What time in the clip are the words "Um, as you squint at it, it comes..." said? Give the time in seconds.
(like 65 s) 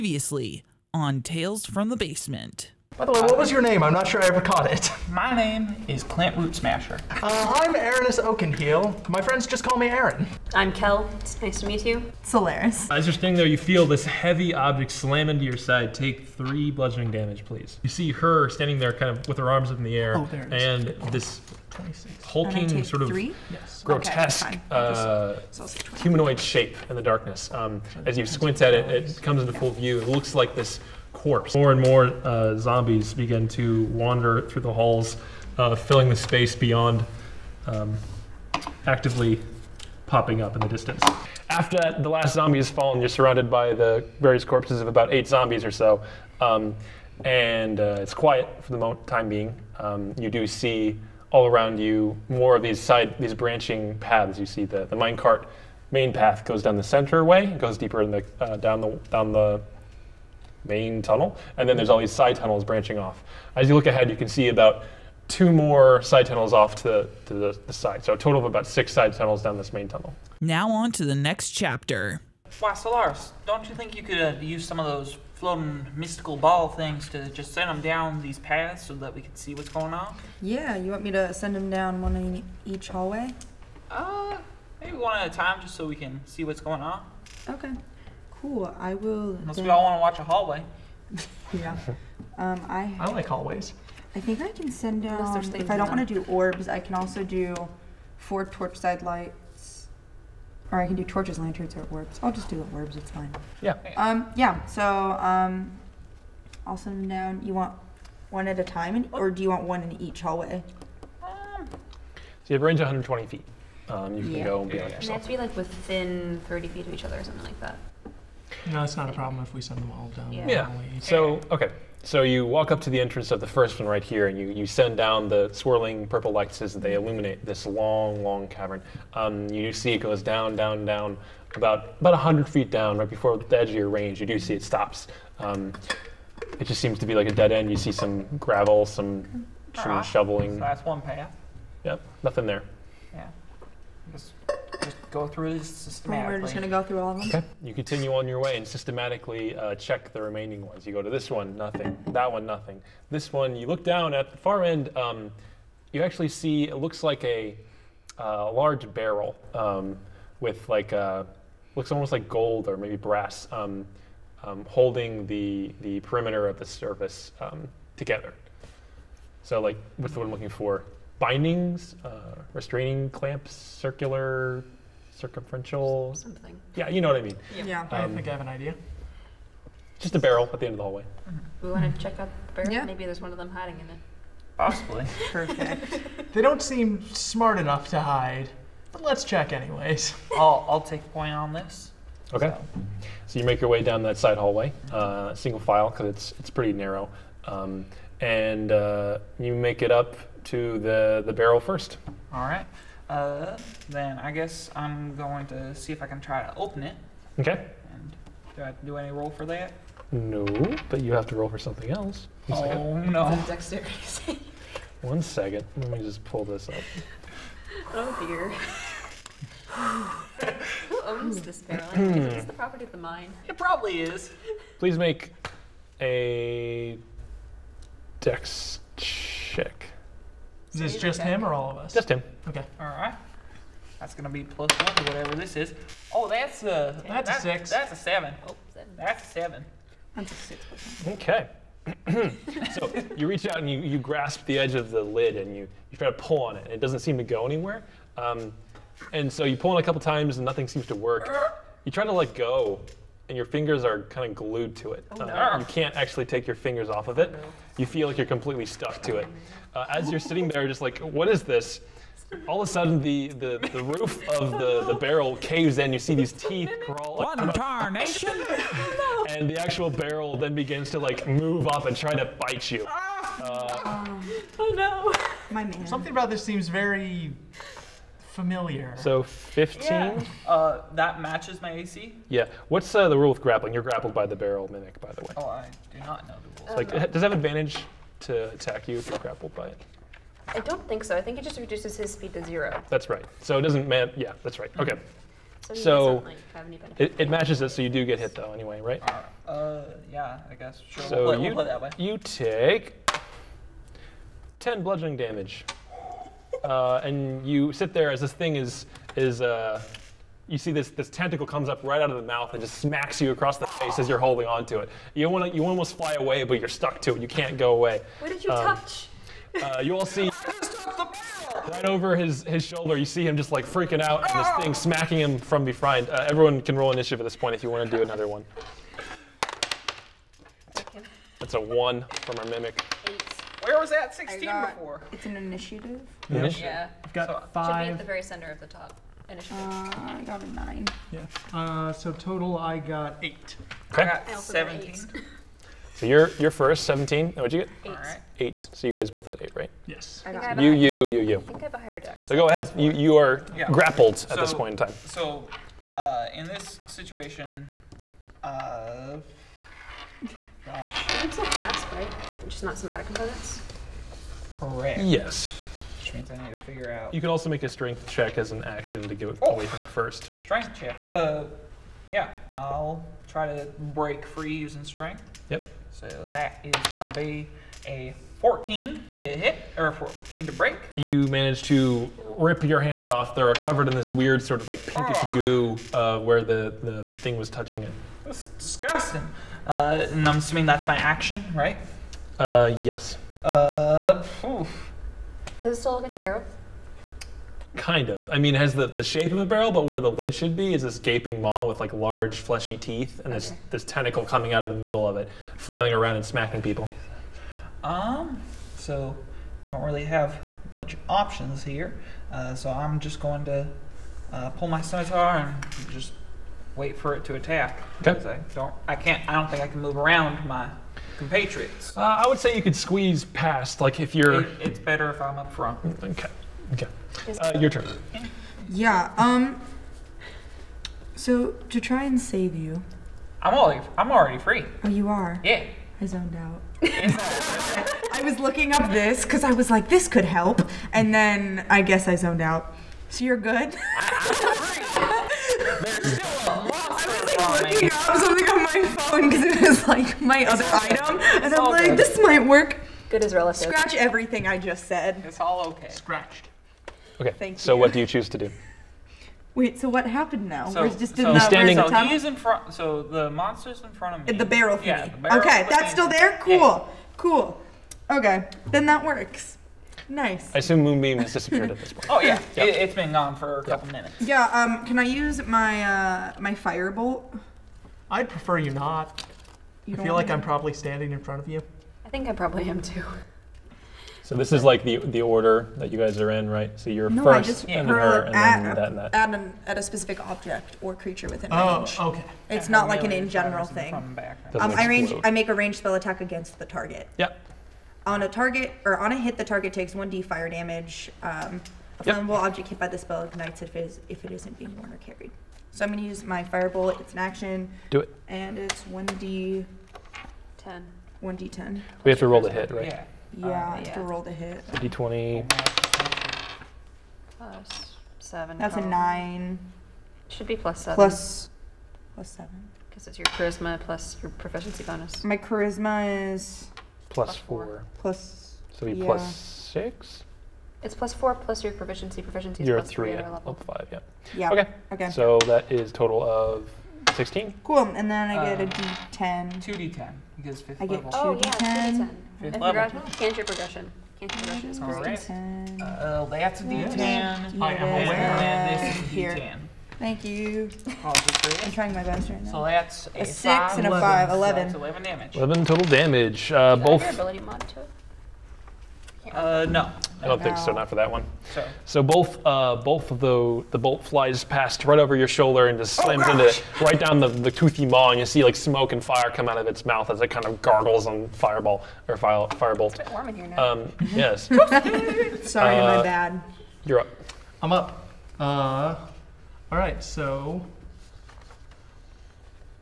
27 s.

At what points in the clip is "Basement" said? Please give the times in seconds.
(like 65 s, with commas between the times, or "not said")
1 s.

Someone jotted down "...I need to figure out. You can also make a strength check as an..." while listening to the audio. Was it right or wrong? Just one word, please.
right.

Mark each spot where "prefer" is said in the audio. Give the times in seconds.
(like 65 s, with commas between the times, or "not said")
478 s.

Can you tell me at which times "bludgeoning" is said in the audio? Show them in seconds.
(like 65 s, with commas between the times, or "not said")
16 s, 304 s.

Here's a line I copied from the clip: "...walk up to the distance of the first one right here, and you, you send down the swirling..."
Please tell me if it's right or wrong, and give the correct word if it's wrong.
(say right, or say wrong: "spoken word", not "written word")
wrong: "entrance", not "distance".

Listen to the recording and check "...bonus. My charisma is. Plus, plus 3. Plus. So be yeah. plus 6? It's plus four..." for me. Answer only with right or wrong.
wrong.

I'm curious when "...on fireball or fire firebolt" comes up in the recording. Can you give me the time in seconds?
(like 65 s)
571 s.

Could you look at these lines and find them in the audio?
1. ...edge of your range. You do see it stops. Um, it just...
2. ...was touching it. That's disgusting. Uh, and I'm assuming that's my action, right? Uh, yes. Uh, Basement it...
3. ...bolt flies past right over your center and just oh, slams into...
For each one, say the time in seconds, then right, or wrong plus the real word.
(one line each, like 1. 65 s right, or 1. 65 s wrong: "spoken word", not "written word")
1. 133 s right
2. 387 s wrong: "Does", not "Basement"
3. 563 s wrong: "shoulder", not "center".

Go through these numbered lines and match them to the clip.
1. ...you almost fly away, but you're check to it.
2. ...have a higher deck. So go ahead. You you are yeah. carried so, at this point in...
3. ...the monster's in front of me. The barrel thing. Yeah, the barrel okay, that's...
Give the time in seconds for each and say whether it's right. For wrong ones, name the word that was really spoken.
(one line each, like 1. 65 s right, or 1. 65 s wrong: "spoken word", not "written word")
1. 315 s wrong: "stuck", not "check"
2. 351 s wrong: "grappled", not "carried"
3. 463 s right.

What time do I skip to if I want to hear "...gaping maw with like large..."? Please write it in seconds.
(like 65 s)
400 s.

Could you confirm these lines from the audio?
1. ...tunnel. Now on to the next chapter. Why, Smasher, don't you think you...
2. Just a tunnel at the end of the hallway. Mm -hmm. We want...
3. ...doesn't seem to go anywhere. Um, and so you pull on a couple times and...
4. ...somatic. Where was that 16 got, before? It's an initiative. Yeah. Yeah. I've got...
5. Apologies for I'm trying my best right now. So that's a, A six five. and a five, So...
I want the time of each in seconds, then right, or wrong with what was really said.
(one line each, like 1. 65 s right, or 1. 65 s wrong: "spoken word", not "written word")
1. 69 s wrong: "Solaris", not "Smasher"
2. 179 s wrong: "barrel", not "tunnel"
3. 246 s right
4. 332 s wrong: "mimic", not "somatic"
5. 550 s right.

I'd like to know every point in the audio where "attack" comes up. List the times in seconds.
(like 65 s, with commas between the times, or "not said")
288 s, 417 s, 495 s.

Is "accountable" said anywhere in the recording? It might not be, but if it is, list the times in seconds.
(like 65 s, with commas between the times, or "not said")
not said.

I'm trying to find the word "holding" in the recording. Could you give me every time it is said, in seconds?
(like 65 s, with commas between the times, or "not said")
164 s, 314 s.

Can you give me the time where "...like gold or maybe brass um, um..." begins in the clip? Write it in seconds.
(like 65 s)
162 s.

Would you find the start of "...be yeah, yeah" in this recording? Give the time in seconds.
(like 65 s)
114 s.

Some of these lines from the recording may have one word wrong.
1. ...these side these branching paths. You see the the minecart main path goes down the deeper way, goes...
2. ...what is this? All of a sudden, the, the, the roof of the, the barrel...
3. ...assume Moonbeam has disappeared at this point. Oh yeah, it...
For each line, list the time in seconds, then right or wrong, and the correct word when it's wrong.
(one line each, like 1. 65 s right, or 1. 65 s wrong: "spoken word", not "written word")
1. 52 s wrong: "center", not "deeper"
2. 260 s right
3. 470 s right.